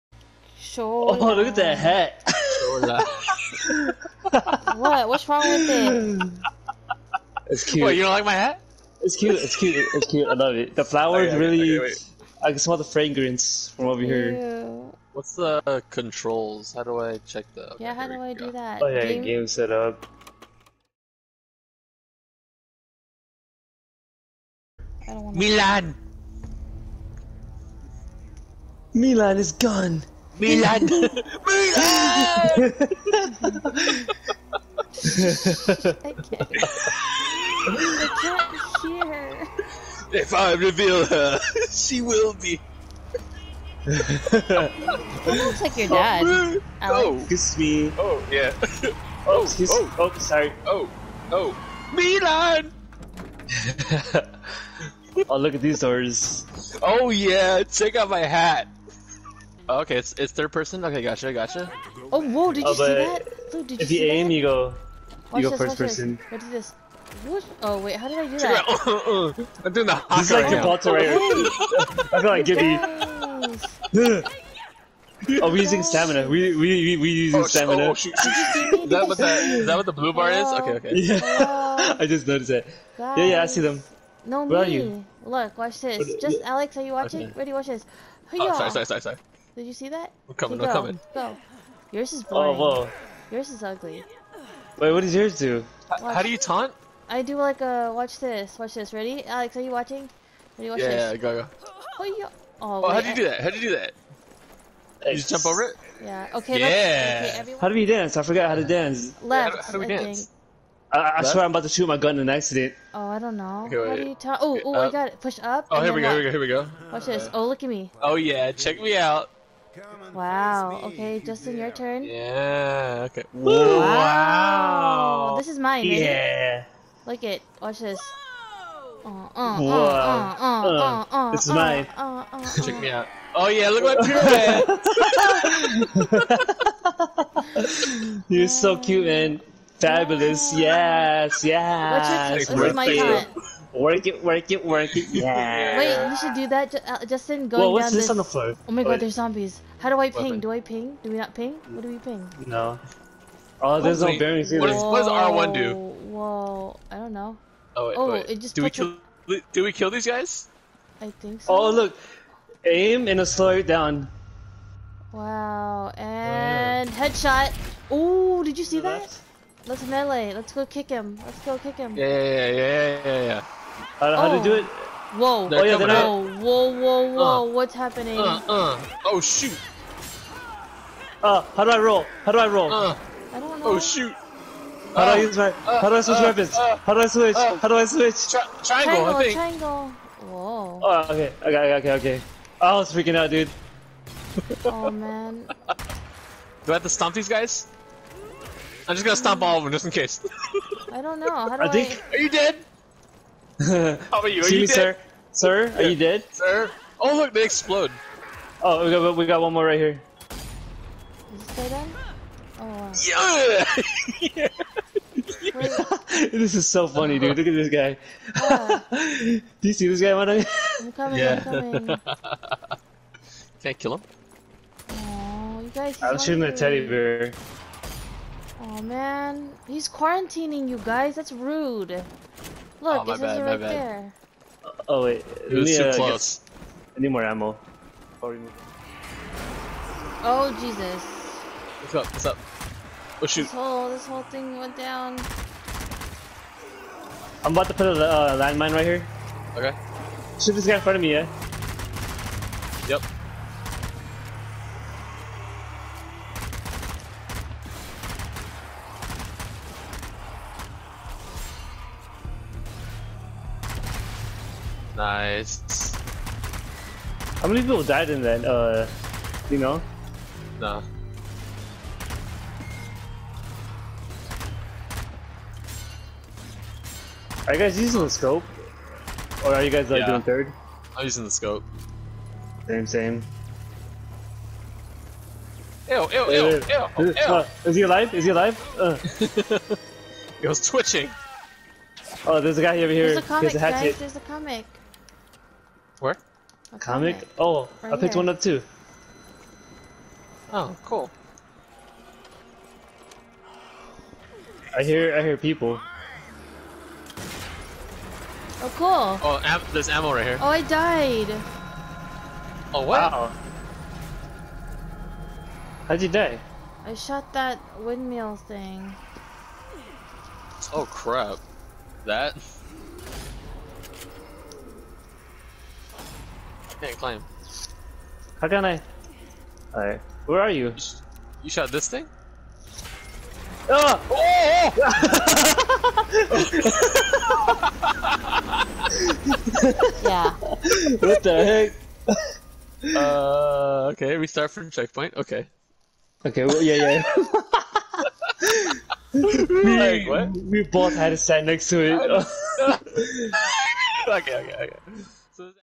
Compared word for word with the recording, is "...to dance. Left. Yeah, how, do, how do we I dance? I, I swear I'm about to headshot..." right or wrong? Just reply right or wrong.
wrong.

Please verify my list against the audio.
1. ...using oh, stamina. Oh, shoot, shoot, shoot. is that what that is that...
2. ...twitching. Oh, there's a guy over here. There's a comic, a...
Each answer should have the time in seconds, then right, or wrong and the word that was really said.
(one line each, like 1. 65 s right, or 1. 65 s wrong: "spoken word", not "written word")
1. 77 s right
2. 290 s right.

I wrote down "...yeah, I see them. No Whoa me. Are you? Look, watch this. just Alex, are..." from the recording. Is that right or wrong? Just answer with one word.
wrong.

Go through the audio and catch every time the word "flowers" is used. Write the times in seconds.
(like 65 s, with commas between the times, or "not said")
10 s.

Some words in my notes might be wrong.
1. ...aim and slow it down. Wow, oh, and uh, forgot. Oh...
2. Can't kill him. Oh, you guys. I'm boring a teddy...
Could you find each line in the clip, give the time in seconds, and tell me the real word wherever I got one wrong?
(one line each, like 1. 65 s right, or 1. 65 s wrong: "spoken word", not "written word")
1. 162 s wrong: "headshot", not "forgot"
2. 223 s wrong: "shooting", not "boring".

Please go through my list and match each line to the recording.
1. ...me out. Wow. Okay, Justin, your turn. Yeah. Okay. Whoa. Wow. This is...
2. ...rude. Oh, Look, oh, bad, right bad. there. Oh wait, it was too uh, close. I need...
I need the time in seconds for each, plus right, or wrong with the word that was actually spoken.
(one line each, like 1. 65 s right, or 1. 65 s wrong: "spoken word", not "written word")
1. 118 s right
2. 231 s right.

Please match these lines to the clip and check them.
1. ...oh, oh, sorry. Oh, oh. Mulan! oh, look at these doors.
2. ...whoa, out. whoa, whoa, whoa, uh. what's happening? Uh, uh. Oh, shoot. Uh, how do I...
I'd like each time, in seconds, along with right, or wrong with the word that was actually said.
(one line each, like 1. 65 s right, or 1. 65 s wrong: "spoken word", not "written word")
1. 49 s right
2. 175 s right.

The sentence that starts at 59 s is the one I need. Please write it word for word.
Oh, okay, it's it's third person.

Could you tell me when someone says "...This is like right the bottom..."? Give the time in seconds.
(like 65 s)
70 s.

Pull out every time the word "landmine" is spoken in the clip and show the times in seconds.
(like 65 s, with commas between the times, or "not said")
248 s.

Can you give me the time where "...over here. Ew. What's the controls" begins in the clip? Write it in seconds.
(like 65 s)
13 s.